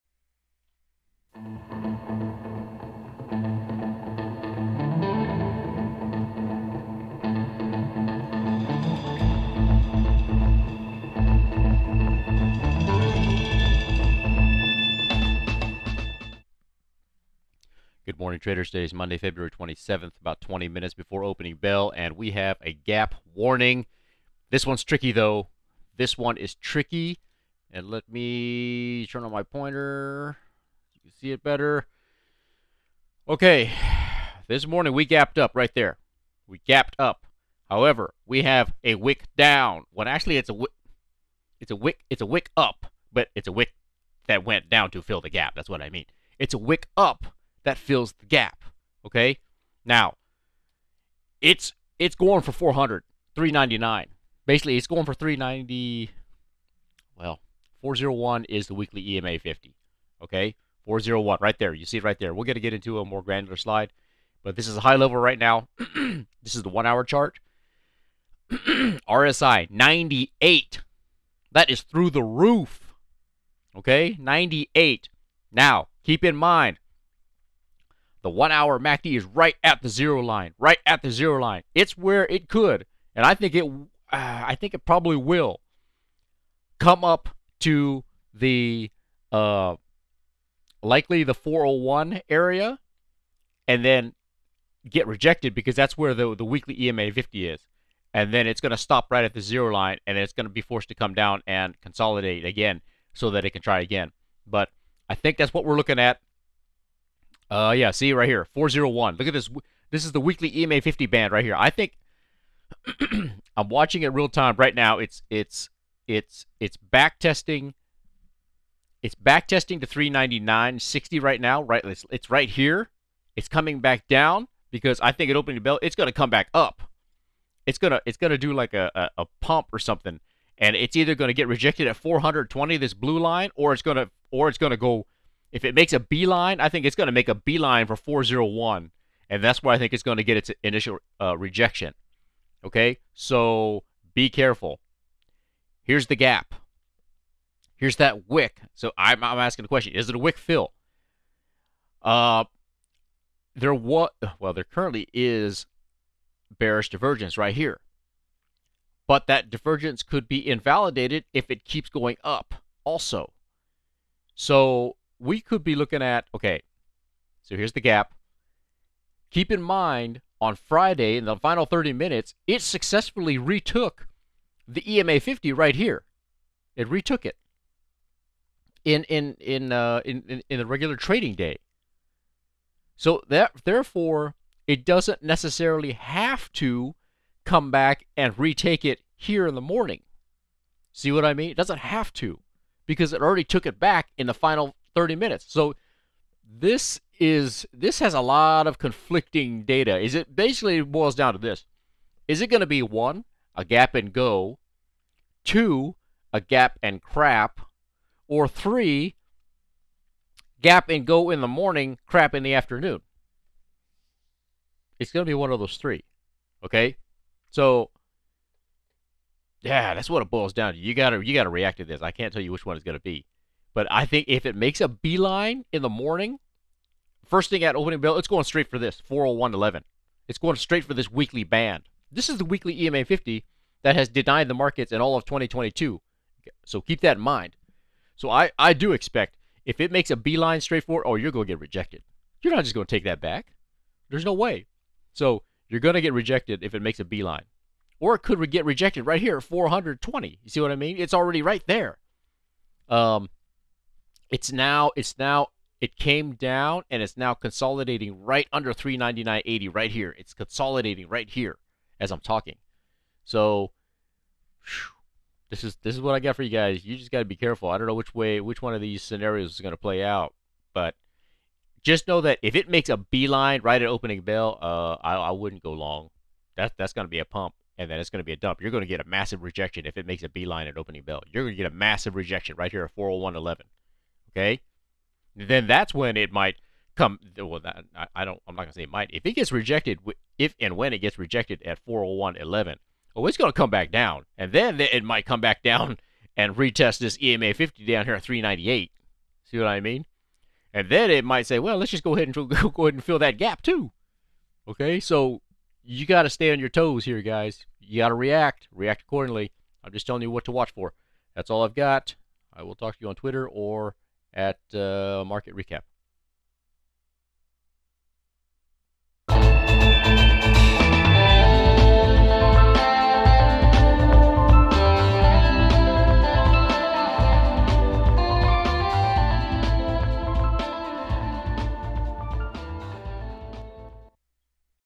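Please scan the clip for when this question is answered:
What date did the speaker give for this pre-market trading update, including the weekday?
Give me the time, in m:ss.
0:18.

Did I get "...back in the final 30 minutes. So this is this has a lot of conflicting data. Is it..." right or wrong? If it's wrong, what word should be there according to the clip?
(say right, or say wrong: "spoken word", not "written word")
right.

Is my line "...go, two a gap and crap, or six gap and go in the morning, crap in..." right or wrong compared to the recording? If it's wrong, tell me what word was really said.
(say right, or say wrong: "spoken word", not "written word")
wrong: "three", not "six".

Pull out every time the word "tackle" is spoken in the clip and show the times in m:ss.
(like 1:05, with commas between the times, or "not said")
not said.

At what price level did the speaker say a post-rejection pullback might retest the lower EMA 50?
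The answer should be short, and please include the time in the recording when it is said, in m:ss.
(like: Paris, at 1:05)
398, at 4:58.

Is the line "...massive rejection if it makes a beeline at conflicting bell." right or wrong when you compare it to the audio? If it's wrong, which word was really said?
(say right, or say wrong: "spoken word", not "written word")
wrong: "opening", not "conflicting".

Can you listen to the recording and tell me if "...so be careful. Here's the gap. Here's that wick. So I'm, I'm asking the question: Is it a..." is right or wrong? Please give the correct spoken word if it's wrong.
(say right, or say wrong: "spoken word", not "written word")
right.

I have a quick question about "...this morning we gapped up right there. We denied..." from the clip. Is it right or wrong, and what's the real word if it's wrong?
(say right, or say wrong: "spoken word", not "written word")
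wrong: "gapped", not "denied".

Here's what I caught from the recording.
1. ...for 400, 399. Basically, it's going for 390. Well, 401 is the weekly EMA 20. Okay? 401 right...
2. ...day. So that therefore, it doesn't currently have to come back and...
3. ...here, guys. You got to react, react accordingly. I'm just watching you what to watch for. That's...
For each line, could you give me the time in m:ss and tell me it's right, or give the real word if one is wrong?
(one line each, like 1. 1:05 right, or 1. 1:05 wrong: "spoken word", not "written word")
1. 0:52 wrong: "50", not "20"
2. 3:01 wrong: "necessarily", not "currently"
3. 5:07 wrong: "telling", not "watching".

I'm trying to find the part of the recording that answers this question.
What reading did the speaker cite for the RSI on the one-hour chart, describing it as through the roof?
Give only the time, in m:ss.
1:08.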